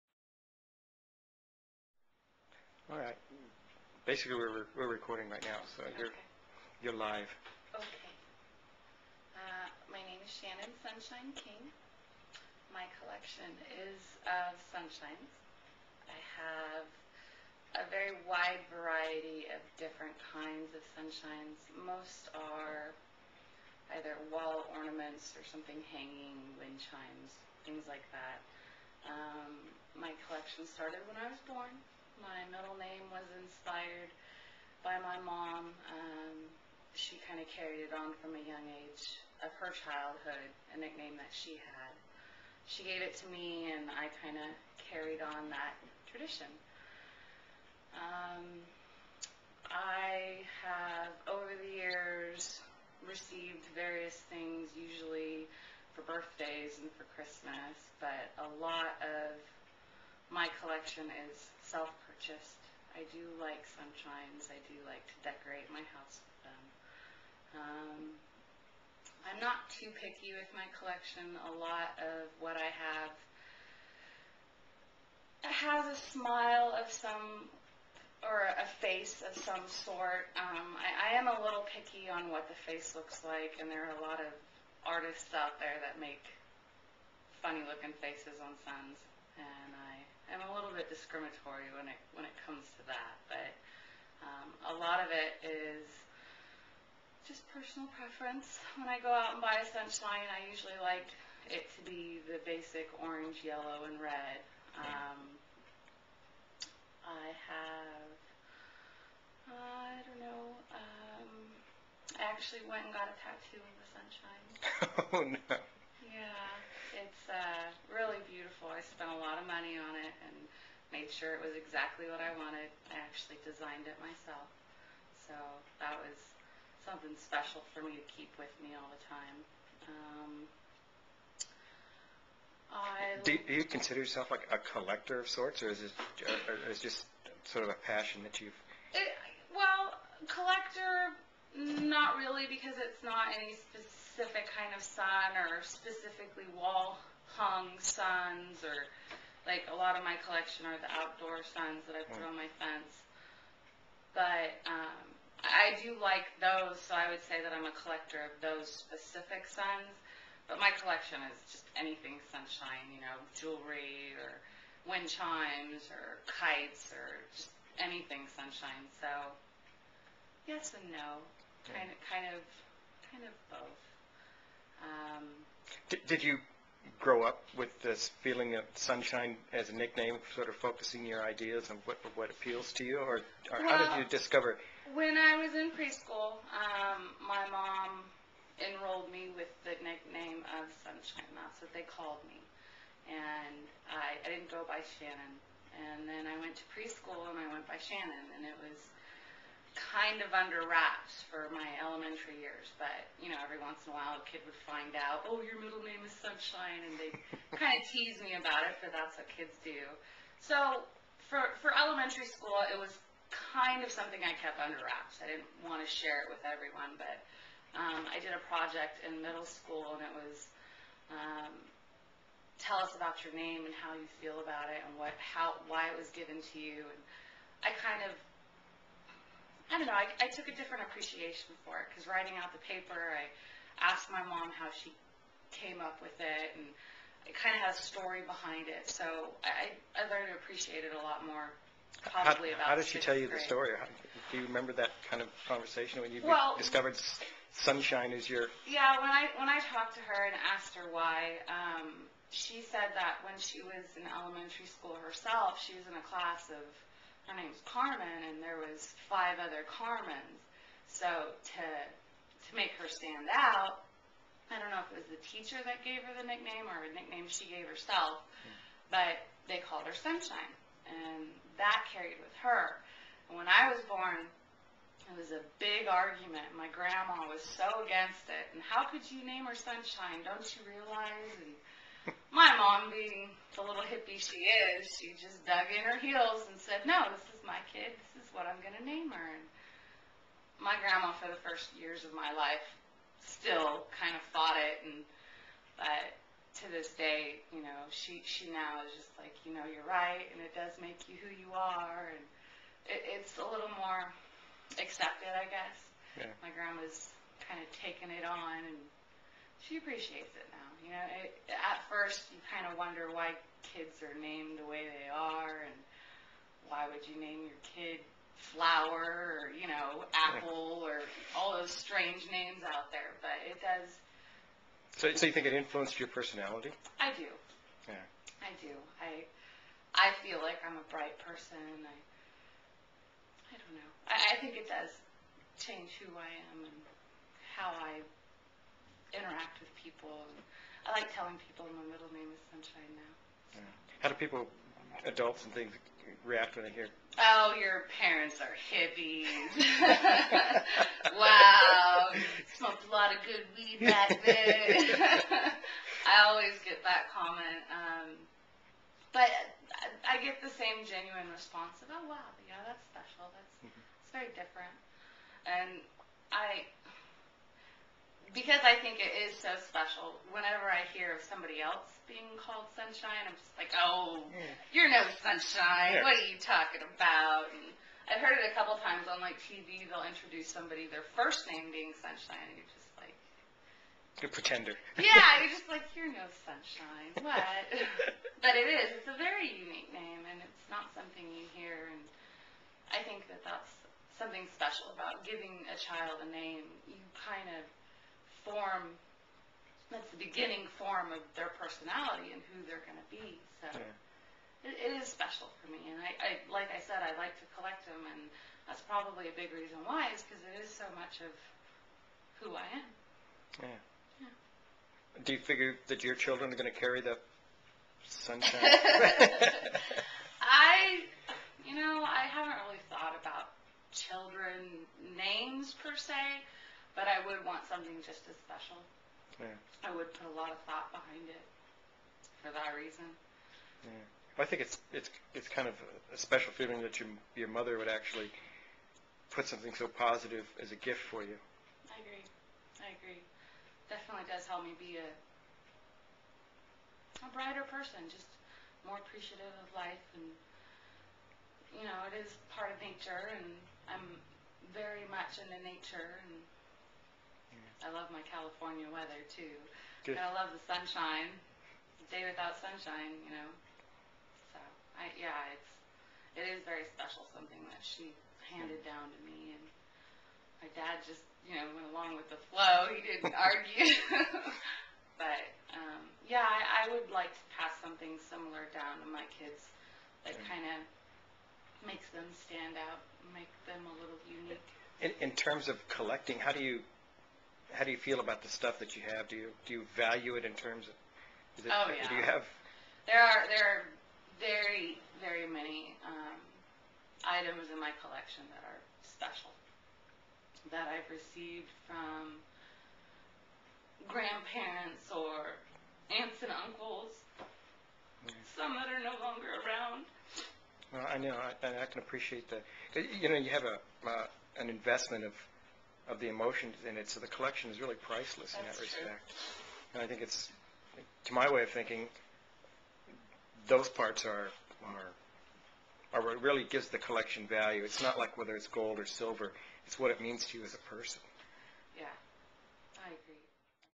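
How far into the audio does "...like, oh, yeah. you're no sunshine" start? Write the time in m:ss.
6:13.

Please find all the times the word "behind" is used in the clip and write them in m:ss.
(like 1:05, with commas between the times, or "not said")
3:58, 7:10.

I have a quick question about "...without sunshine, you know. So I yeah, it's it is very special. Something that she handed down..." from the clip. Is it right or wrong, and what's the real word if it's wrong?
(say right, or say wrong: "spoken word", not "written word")
right.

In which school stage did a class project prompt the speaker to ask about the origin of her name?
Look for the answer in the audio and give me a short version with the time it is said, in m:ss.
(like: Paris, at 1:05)
middle school, at 3:39.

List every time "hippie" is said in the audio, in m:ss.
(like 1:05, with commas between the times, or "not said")
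4:43, 5:48.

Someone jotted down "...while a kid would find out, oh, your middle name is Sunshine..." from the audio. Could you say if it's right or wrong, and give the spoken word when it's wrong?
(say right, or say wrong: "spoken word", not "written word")
right.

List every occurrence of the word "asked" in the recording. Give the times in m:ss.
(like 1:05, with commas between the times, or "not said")
3:53, 4:10.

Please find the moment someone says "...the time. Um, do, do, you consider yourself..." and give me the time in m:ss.
2:08.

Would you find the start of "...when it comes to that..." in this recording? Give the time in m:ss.
1:32.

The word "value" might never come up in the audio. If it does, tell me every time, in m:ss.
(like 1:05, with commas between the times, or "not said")
8:09, 8:47.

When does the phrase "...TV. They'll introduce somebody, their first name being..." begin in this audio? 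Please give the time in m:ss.
6:19.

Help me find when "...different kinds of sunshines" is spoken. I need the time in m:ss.
0:19.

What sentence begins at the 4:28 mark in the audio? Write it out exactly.
but they called her Sunshine, and that carried with her.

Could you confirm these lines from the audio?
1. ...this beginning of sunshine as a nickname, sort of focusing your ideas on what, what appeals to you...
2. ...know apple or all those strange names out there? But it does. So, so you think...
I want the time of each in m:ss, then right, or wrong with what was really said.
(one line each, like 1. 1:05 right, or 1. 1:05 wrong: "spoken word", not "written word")
1. 2:57 wrong: "feeling", not "beginning"
2. 5:19 right.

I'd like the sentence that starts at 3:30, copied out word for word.
So for for elementary school, it was kind of something I kept under wraps.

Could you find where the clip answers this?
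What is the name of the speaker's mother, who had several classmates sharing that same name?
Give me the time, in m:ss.
4:17.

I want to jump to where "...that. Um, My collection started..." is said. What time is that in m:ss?
0:28.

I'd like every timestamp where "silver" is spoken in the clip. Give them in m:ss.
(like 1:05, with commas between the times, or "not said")
8:49.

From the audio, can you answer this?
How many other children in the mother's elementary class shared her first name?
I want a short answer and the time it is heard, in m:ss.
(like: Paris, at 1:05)
5, at 4:19.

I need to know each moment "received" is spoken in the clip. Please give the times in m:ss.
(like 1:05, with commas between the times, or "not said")
0:53, 8:21.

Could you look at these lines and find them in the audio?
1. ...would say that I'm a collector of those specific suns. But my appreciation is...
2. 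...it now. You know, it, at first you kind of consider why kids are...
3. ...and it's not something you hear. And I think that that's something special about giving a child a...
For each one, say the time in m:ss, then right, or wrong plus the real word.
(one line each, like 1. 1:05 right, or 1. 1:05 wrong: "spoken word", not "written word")
1. 2:37 wrong: "collection", not "appreciation"
2. 5:10 wrong: "wonder", not "consider"
3. 6:30 right.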